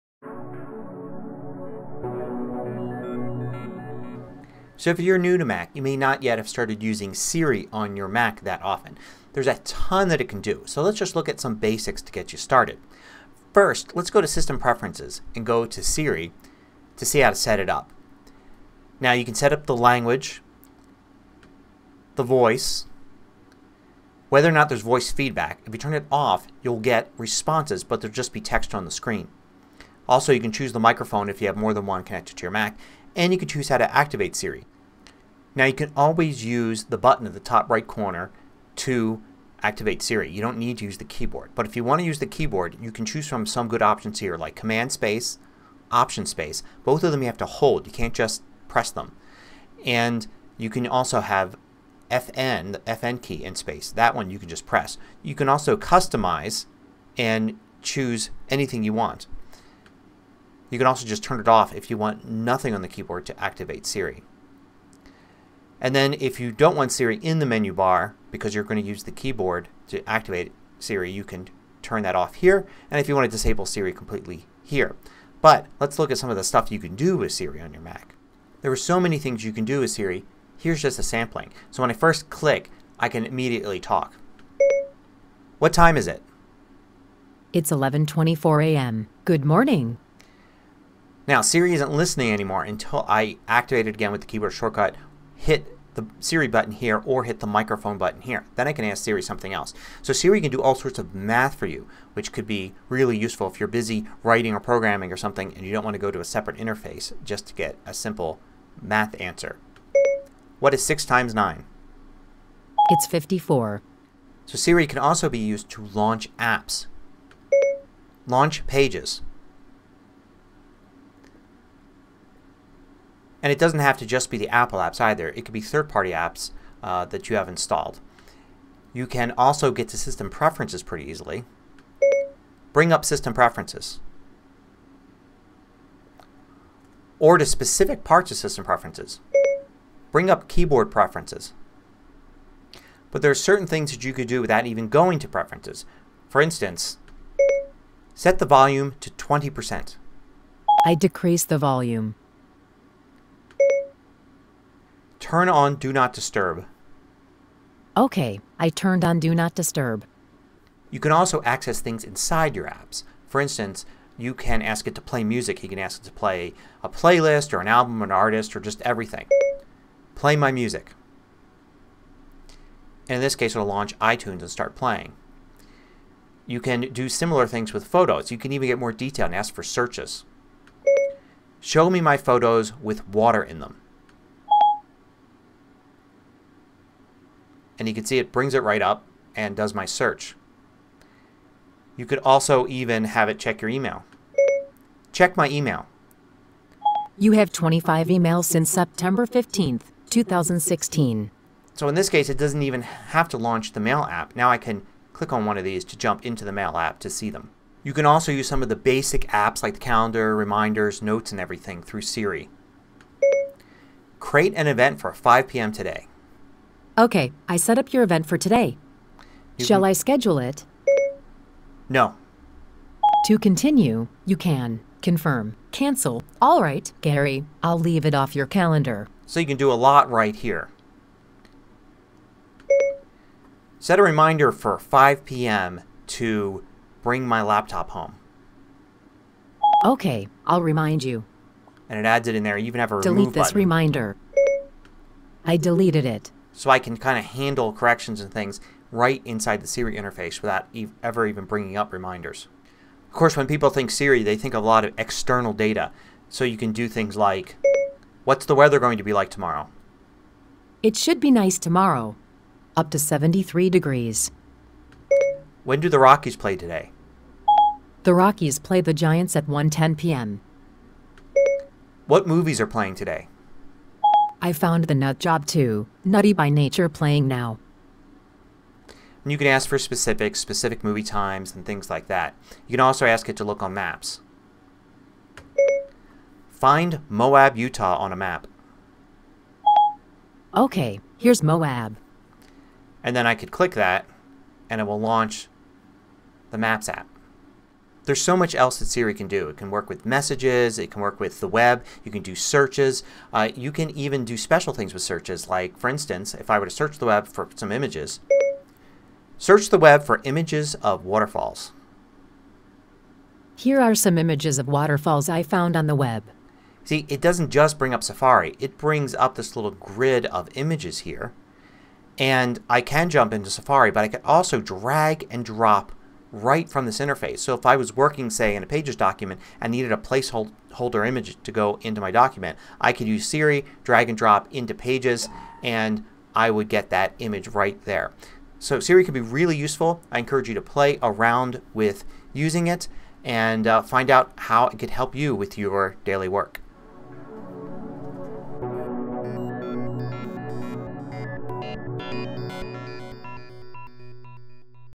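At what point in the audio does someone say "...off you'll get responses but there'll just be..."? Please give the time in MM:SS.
00:26.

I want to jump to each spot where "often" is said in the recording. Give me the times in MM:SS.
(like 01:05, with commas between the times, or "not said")
00:08.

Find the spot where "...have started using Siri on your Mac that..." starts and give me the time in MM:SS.
00:06.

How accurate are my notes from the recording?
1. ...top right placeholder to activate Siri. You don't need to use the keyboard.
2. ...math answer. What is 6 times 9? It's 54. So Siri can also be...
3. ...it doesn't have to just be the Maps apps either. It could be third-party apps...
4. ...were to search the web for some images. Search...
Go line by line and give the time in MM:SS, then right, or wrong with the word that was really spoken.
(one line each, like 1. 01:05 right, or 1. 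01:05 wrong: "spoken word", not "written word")
1. 00:37 wrong: "corner", not "placeholder"
2. 01:48 right
3. 02:03 wrong: "Apple", not "Maps"
4. 05:06 right.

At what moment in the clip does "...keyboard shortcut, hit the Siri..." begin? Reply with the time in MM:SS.
01:34.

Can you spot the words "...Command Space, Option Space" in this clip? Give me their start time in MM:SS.
00:44.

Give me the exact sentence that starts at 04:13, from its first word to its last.
Of course when people think Siri they think of a lot of external data.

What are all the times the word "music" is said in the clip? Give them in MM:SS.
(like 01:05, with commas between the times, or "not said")
02:45, 02:50.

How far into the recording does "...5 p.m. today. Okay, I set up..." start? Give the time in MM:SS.
03:35.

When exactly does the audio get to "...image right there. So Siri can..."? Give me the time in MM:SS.
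05:37.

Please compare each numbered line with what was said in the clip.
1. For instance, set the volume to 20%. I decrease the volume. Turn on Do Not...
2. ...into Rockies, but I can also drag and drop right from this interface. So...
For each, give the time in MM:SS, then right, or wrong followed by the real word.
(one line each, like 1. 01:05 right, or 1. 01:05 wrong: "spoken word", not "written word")
1. 02:26 right
2. 05:23 wrong: "Safari", not "Rockies".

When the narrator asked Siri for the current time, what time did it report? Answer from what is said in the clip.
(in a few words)
11:24 a.m.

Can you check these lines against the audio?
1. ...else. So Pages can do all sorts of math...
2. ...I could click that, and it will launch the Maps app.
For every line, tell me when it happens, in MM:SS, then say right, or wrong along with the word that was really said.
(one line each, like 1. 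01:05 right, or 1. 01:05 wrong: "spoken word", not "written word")
1. 01:39 wrong: "Siri", not "Pages"
2. 04:53 right.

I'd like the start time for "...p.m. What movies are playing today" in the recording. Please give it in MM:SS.
04:29.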